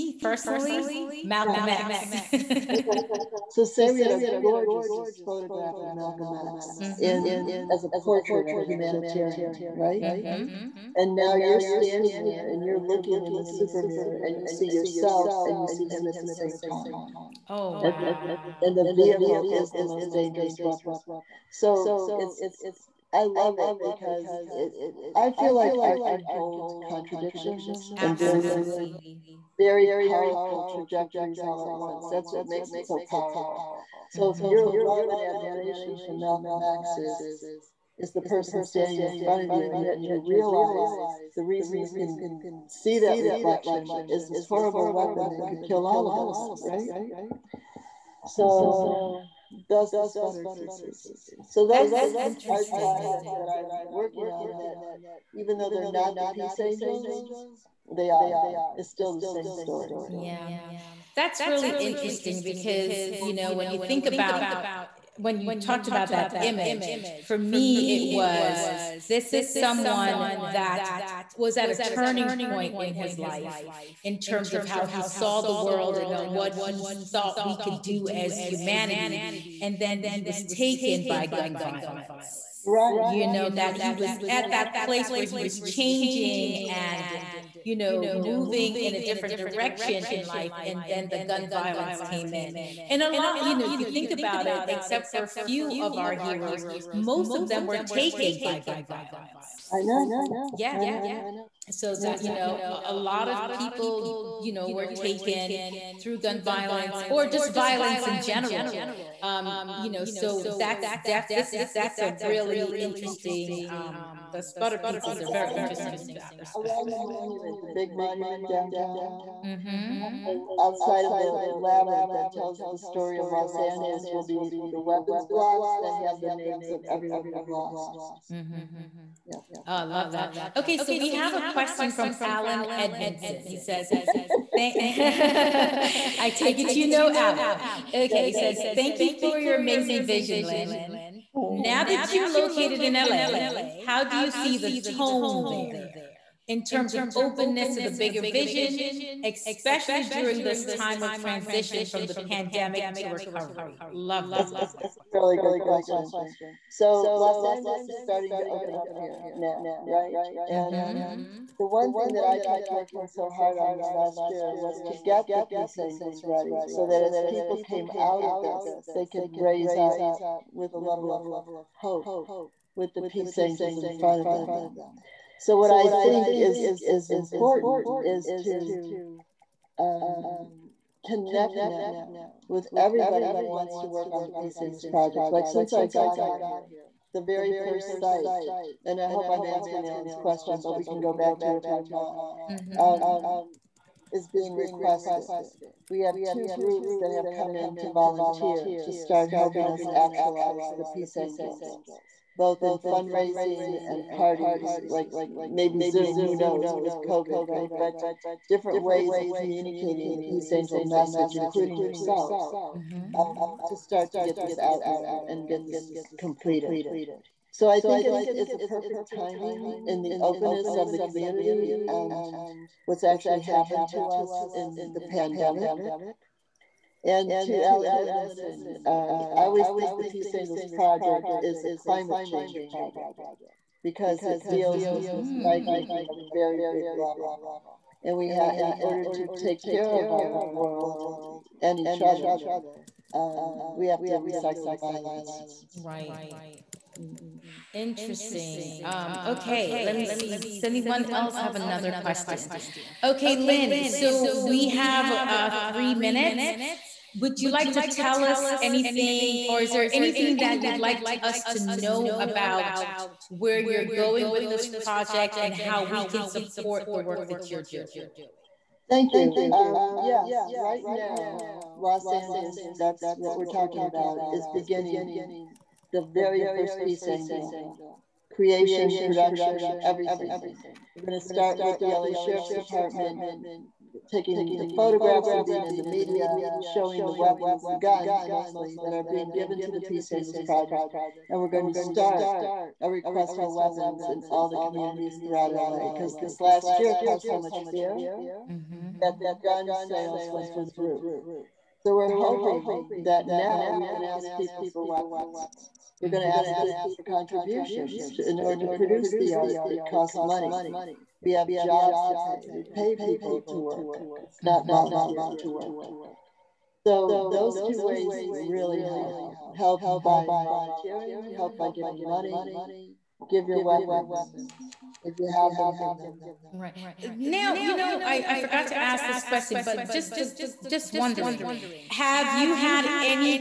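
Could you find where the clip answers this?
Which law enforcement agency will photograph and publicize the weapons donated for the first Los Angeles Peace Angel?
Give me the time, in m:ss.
4:41.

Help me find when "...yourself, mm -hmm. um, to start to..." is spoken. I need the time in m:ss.
3:31.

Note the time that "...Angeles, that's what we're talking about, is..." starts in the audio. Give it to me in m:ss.
4:32.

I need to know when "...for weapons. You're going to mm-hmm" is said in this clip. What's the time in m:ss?
5:04.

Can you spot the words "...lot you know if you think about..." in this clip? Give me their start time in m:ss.
1:33.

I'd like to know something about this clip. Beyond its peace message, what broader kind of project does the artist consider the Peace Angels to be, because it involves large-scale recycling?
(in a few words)
A climate change project.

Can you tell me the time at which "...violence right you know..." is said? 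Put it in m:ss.
1:21.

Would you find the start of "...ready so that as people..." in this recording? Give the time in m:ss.
2:46.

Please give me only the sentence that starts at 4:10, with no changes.
Does anyone else have another question?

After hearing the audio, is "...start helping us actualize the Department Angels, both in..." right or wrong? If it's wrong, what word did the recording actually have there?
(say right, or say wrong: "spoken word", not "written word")
wrong: "Peace", not "Department".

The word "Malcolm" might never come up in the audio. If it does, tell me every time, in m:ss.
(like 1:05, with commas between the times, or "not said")
0:01, 0:05, 0:36.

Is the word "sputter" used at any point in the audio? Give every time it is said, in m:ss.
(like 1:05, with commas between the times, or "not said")
0:50, 1:54.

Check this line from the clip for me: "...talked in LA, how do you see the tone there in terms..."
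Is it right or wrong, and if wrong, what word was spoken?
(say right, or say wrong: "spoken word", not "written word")
wrong: "located", not "talked".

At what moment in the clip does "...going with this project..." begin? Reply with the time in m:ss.
4:23.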